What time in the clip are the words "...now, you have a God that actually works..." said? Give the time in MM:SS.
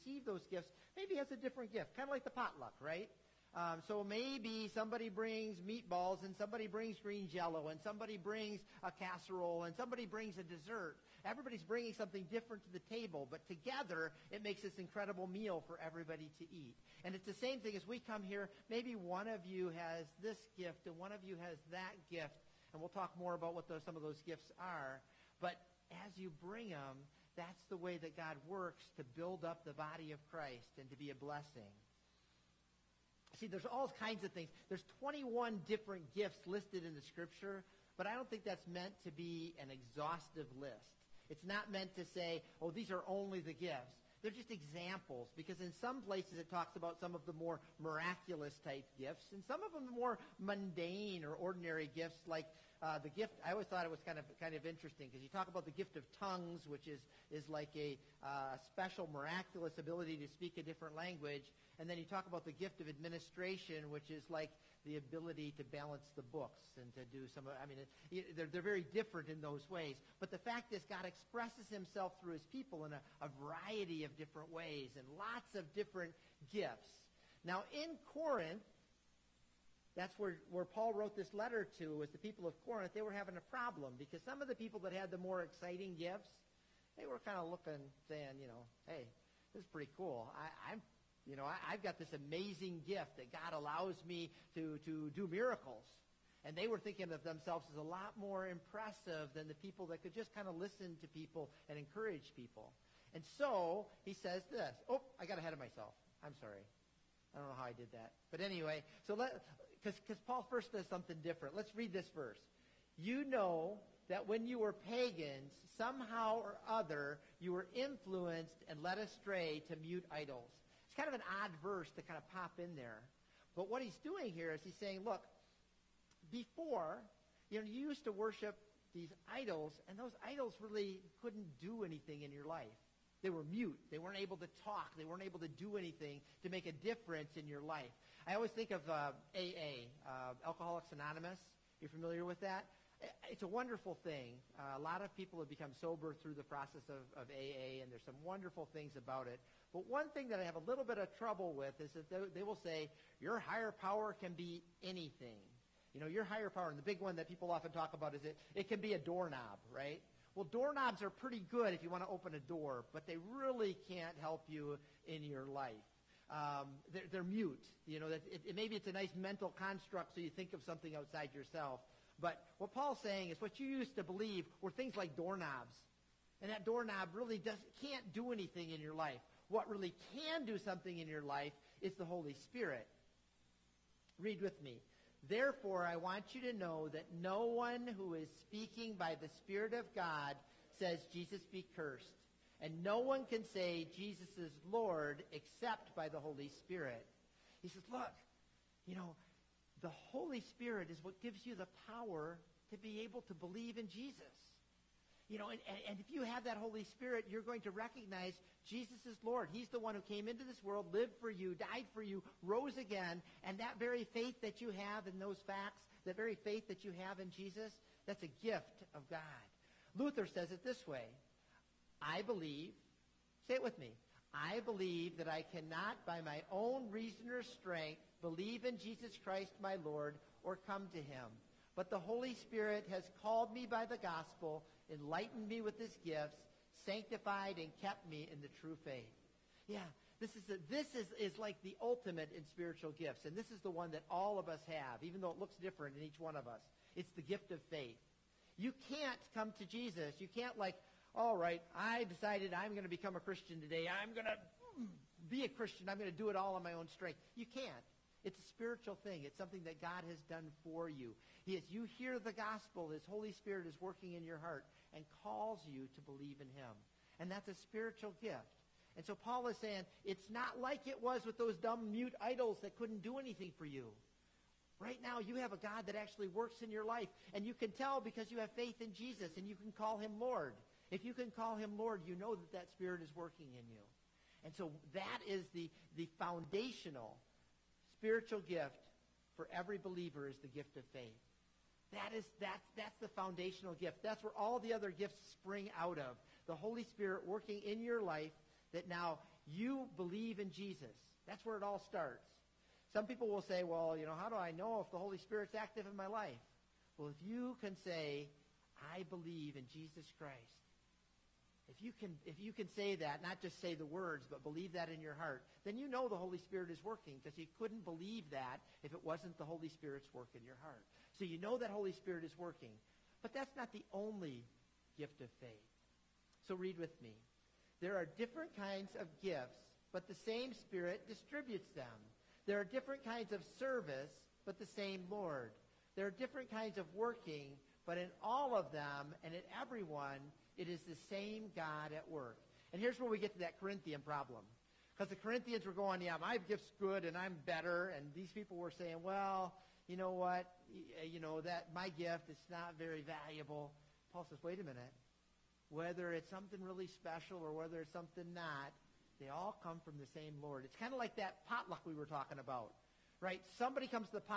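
04:35.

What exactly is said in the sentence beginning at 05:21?
So you know that Holy Spirit is working.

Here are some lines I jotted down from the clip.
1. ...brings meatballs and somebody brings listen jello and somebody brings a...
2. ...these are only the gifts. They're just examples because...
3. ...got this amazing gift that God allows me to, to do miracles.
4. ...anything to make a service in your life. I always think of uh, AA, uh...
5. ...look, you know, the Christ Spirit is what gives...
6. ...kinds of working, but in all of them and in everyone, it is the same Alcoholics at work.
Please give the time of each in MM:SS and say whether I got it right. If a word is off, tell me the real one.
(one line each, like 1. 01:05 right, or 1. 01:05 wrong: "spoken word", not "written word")
1. 00:05 wrong: "green", not "listen"
2. 00:42 right
3. 01:31 right
4. 02:15 wrong: "difference", not "service"
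5. 03:17 wrong: "Holy", not "Christ"
6. 05:36 wrong: "God", not "Alcoholics".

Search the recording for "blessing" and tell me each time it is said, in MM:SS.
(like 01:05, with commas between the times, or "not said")
00:31.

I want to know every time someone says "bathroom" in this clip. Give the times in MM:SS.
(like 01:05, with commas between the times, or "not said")
not said.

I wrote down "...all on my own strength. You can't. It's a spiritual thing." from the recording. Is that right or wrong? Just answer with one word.
right.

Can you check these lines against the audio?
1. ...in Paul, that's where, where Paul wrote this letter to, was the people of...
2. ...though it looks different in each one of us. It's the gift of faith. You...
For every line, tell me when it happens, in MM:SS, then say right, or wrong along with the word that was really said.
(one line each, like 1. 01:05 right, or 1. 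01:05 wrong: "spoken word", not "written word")
1. 01:17 wrong: "Corinth", not "Paul"
2. 04:05 right.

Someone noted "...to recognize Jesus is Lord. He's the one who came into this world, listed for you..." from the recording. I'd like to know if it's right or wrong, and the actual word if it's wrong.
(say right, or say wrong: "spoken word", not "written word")
wrong: "lived", not "listed".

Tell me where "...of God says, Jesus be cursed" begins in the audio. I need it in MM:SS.
03:09.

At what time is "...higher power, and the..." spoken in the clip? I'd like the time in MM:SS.
02:36.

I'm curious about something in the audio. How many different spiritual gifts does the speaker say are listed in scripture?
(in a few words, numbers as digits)
21.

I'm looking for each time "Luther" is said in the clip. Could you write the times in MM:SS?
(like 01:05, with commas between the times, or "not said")
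03:39.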